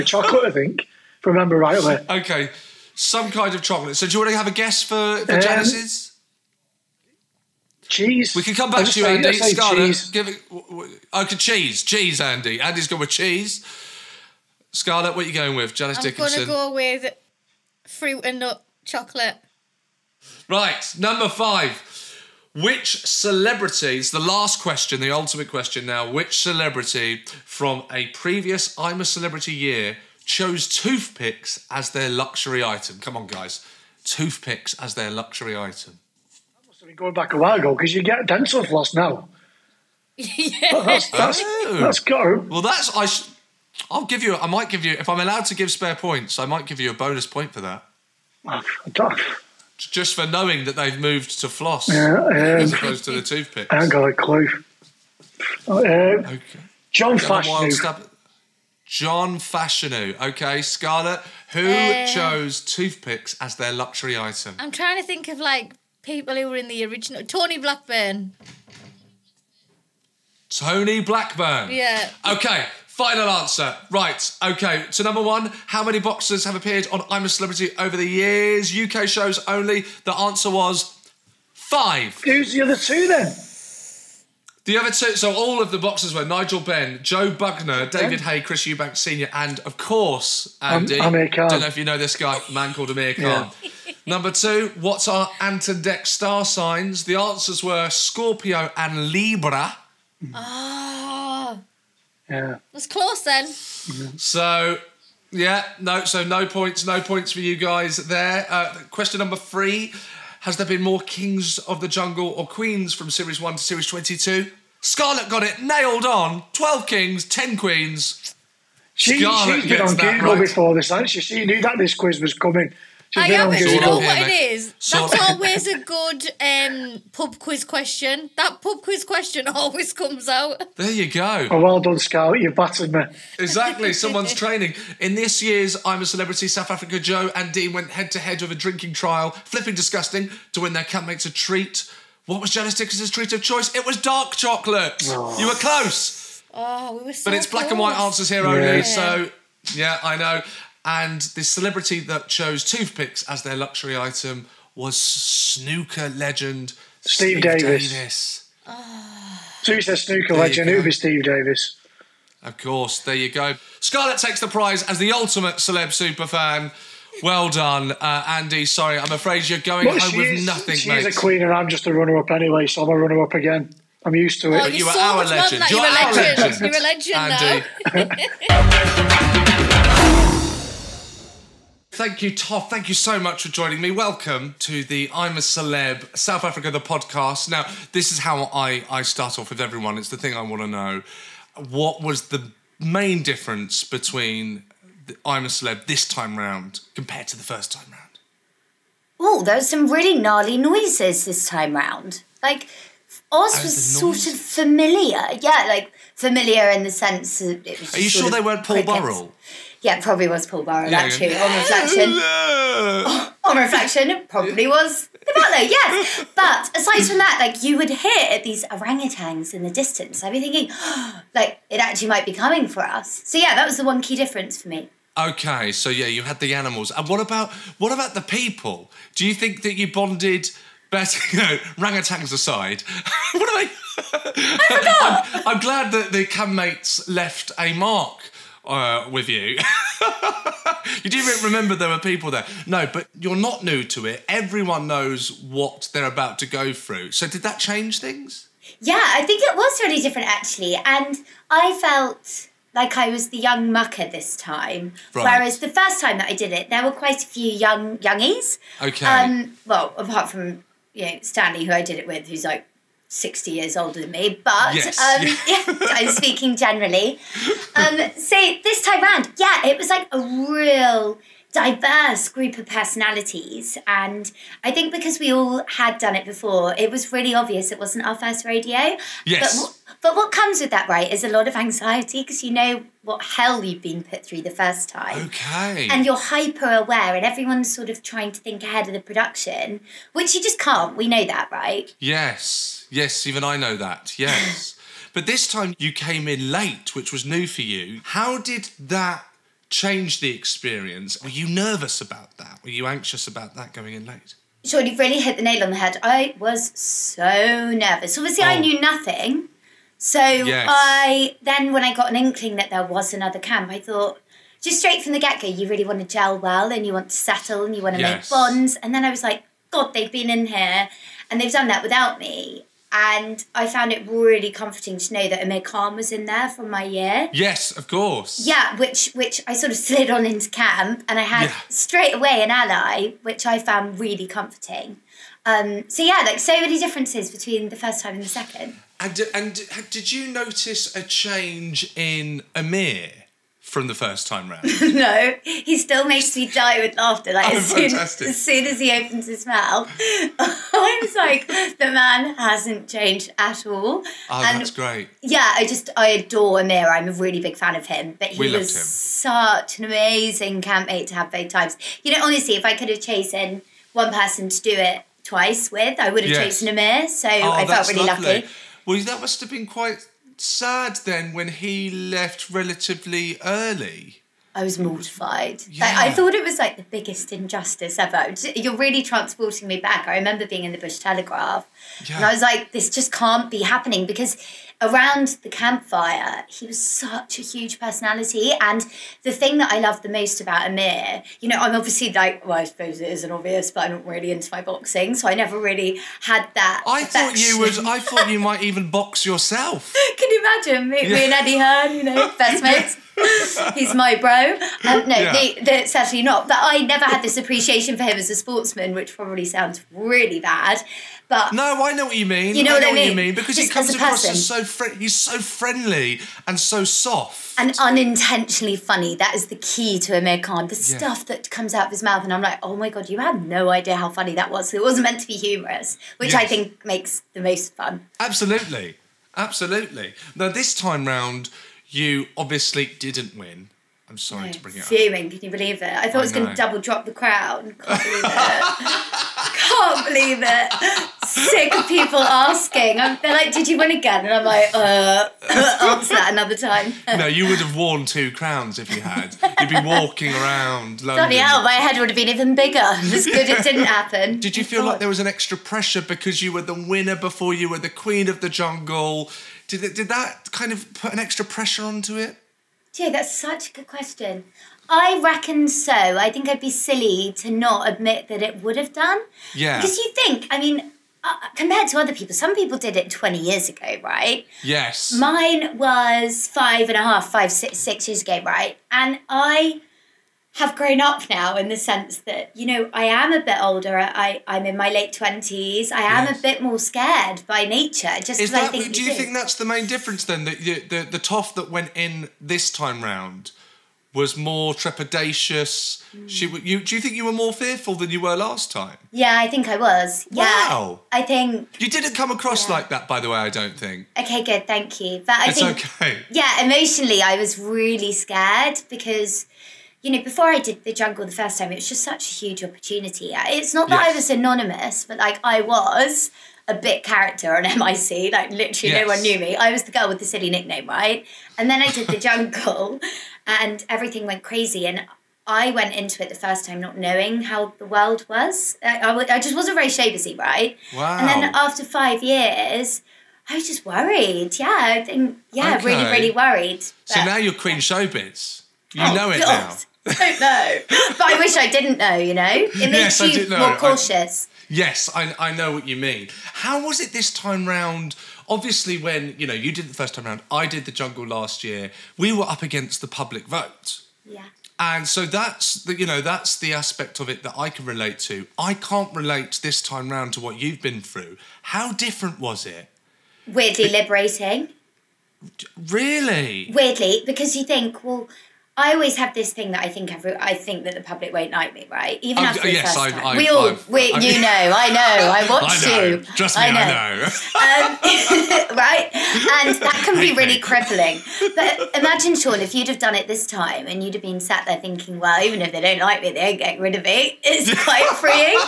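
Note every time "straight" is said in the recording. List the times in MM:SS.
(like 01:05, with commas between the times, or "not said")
05:14, 05:31.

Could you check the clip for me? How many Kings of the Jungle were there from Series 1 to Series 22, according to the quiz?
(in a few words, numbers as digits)
12.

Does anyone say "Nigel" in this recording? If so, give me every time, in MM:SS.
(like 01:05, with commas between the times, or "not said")
01:26.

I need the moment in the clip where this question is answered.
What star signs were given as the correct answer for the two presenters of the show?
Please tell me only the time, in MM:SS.
01:37.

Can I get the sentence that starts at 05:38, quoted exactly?
And and did you notice a change in Amir?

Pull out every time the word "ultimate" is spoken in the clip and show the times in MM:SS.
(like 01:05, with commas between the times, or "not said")
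00:25, 02:45.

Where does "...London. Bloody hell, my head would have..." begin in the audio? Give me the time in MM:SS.
07:31.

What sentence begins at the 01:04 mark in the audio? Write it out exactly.
I'm trying to think of like people who were in the original.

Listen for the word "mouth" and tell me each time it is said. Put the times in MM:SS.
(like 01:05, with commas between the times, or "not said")
05:49, 07:02.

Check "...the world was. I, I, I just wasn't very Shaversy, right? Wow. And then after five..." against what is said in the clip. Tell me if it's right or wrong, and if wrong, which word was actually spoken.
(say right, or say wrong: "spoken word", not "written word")
right.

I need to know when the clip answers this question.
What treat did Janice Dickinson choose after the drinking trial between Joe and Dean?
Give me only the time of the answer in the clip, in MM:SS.
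02:23.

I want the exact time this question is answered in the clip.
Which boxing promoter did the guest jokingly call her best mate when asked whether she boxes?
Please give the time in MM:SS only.
06:41.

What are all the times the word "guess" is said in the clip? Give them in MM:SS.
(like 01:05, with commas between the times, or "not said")
00:04.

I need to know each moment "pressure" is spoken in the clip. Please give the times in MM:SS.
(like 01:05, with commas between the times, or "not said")
07:35, 07:41.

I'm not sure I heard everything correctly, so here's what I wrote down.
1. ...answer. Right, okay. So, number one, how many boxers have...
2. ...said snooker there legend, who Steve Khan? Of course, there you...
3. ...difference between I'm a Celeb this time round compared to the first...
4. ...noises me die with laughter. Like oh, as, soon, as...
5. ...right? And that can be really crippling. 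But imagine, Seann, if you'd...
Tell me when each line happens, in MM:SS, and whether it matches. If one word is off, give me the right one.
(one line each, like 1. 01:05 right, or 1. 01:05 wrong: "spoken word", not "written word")
1. 01:13 right
2. 02:39 wrong: "Davis", not "Khan"
3. 03:13 right
4. 05:46 wrong: "makes", not "noises"
5. 09:38 right.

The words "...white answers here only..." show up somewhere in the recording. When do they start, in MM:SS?
02:27.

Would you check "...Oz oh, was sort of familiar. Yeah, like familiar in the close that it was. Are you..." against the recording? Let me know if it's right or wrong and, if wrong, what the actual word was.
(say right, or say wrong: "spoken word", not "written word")
wrong: "sense", not "close".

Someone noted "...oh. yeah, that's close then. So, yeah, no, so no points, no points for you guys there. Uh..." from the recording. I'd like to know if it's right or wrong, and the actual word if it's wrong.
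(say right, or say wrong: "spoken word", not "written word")
right.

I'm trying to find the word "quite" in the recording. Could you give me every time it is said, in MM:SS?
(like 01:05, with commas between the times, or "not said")
04:16, 06:09, 09:47.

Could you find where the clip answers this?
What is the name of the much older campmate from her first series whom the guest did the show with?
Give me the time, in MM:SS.
04:21.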